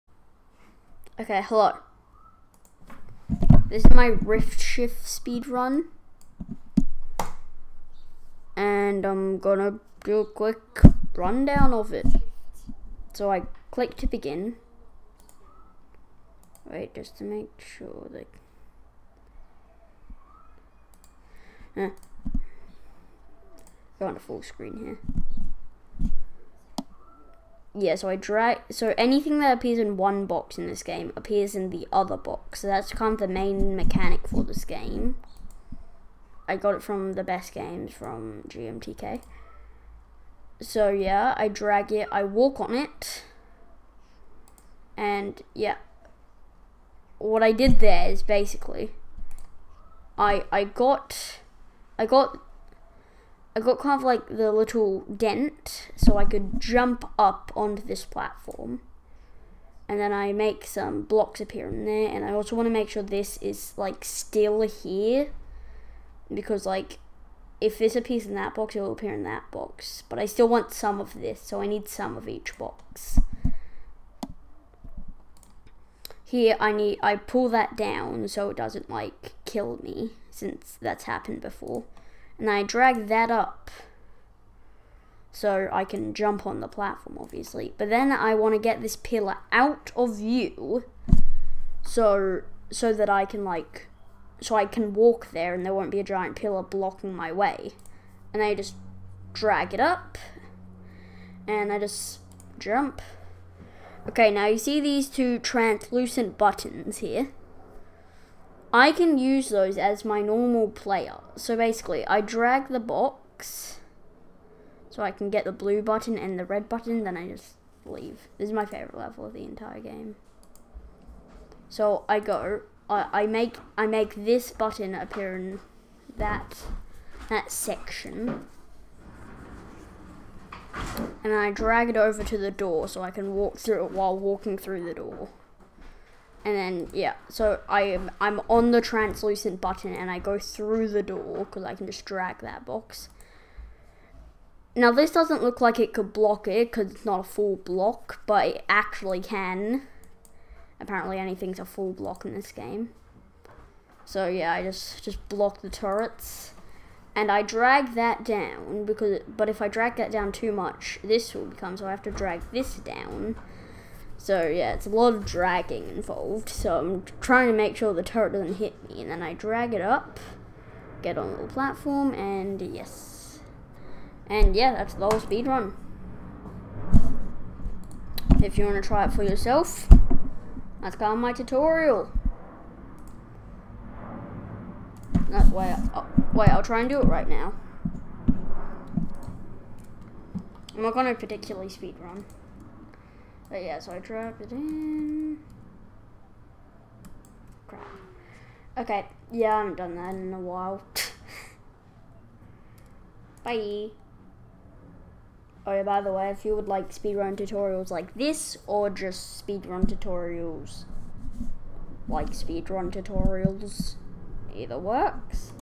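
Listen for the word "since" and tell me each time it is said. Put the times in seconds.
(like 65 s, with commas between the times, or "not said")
80 s.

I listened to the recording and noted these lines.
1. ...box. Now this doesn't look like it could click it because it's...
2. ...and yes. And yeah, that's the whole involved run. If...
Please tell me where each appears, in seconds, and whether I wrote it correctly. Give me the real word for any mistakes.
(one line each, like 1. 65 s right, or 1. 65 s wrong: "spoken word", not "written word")
1. 142 s wrong: "block", not "click"
2. 172 s wrong: "speed", not "involved".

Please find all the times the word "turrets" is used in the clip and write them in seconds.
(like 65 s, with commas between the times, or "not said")
155 s, 168 s.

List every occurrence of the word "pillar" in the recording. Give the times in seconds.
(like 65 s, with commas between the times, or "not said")
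88 s, 96 s.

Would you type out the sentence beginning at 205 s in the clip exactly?
Oh yeah, by the way, if you would like speedrun tutorials like this, or just speedrun tutorials like speedrun tutorials, either works.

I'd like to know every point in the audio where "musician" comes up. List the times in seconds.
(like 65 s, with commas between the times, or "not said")
not said.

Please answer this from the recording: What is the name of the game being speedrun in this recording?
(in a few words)
Rift Shift.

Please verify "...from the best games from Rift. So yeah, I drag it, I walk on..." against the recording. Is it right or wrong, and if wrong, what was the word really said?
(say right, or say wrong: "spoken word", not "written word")
wrong: "GMTK", not "Rift".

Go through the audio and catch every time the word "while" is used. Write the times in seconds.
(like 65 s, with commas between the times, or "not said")
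133 s, 200 s.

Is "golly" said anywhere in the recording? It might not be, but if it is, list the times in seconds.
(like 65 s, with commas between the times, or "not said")
not said.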